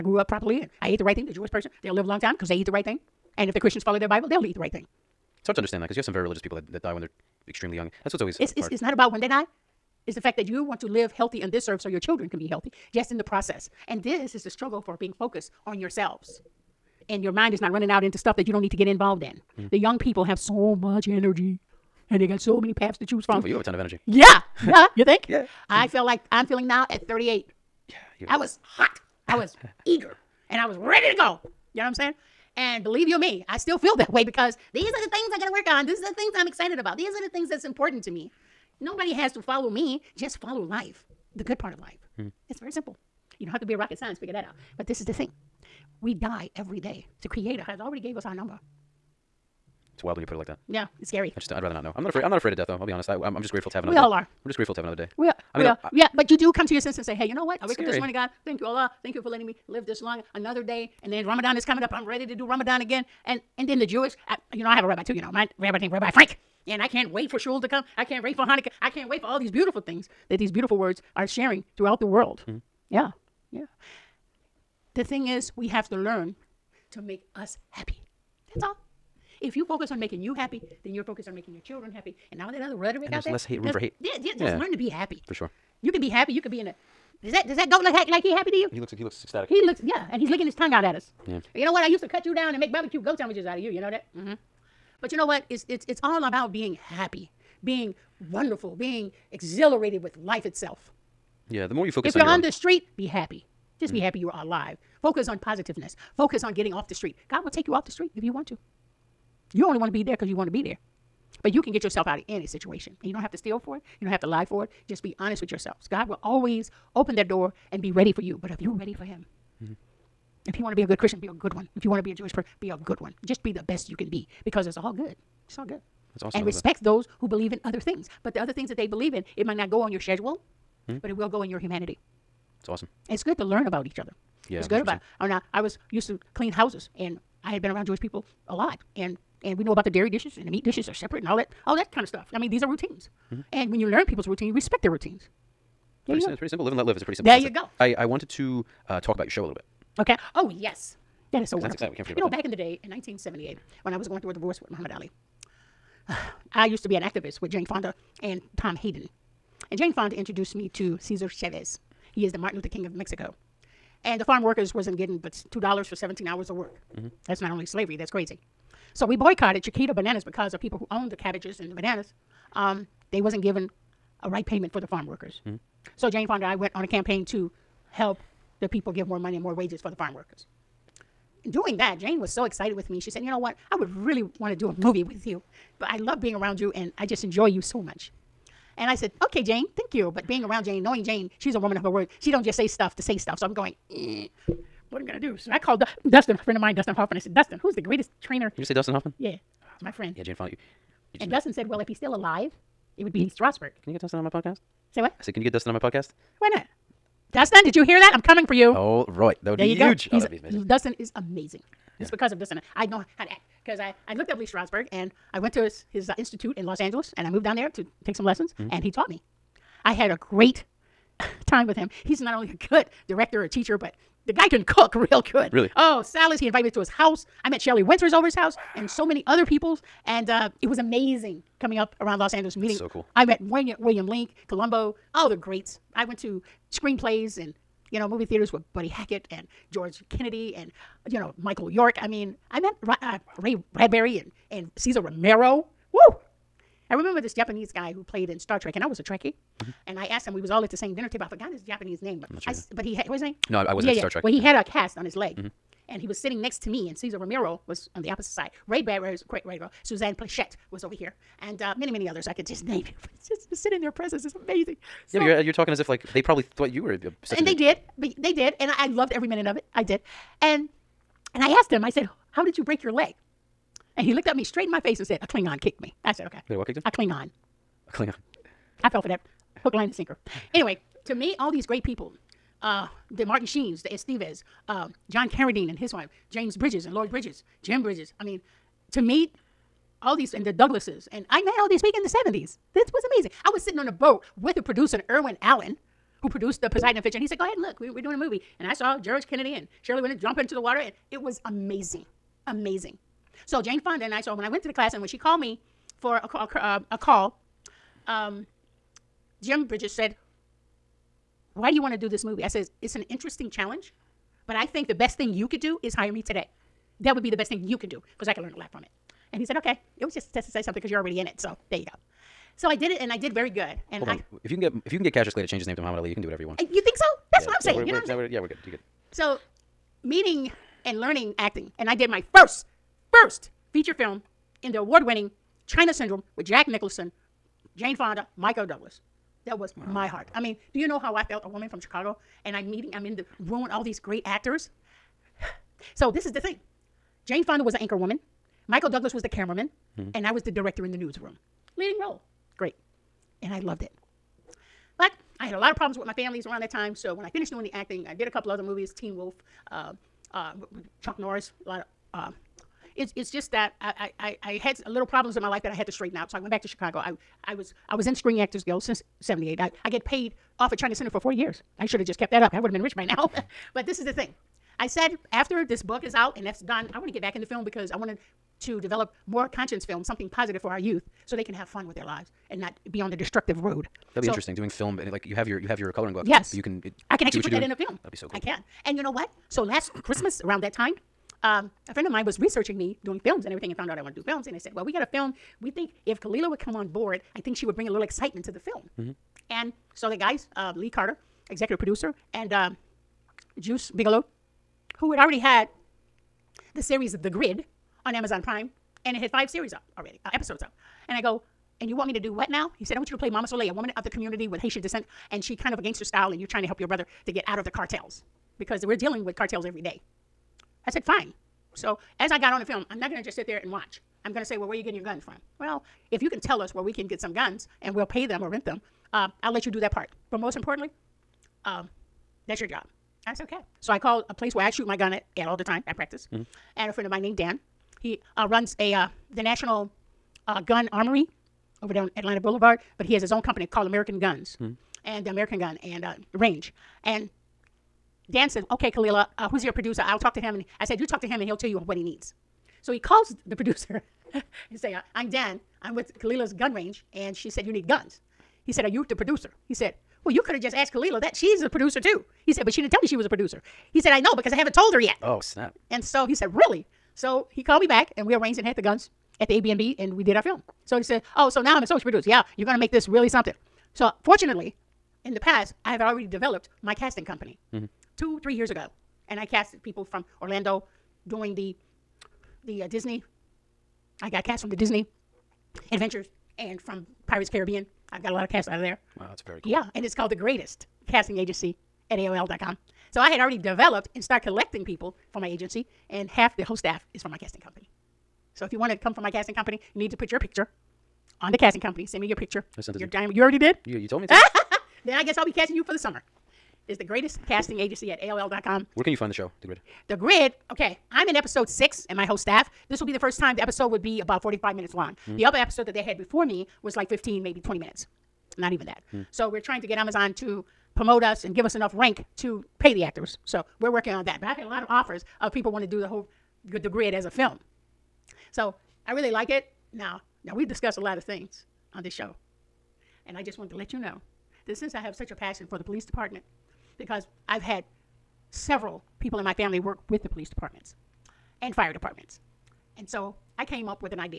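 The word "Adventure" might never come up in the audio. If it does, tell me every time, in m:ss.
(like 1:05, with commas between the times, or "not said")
4:56, 8:05.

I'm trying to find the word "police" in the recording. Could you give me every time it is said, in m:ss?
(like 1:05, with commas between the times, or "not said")
8:55, 9:00.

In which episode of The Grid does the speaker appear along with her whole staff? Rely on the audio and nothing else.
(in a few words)
Episode 6.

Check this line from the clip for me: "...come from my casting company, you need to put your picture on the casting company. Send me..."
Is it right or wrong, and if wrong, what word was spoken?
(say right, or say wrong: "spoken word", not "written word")
right.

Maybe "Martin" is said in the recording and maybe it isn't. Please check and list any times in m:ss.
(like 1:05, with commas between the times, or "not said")
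2:42, 4:43.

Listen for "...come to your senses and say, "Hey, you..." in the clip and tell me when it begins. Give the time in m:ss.
0:56.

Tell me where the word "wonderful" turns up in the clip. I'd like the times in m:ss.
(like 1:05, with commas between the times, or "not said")
1:38, 2:31.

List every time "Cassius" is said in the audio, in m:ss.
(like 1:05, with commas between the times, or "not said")
5:25.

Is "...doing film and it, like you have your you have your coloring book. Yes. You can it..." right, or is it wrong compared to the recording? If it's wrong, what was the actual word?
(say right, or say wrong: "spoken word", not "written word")
right.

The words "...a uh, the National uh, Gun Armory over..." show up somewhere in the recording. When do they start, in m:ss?
7:18.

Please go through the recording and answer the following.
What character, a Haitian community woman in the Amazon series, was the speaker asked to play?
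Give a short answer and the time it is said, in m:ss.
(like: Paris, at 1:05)
Mama Soleil, at 6:53.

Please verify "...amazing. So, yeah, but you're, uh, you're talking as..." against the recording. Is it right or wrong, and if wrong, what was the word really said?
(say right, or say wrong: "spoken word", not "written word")
right.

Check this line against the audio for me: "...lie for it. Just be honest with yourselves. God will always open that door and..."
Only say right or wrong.
right.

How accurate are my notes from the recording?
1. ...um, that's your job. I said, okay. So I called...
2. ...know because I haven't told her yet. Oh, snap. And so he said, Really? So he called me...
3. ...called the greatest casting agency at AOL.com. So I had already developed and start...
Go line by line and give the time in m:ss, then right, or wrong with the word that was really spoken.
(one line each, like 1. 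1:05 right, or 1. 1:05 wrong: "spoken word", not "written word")
1. 7:11 right
2. 7:44 right
3. 8:10 right.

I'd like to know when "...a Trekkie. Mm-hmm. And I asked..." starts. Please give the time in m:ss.
4:08.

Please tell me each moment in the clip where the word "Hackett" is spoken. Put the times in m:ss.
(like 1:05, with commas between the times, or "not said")
3:58.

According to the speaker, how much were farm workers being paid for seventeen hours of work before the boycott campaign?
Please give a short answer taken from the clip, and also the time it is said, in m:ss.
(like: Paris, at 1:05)
2 dollars, at 2:45.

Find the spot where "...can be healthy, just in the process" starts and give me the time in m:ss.
0:12.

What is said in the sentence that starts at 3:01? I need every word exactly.
Doing that, Jane was so excited with me.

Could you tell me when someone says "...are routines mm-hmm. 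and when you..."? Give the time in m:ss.
2:22.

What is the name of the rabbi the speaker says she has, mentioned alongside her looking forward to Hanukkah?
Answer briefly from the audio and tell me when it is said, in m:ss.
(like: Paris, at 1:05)
Rabbi Frank, at 1:05.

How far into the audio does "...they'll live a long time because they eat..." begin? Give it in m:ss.
0:01.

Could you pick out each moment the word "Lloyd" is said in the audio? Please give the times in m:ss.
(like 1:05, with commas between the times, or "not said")
4:46.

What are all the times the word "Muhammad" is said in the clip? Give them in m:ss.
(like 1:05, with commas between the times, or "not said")
2:34, 5:25.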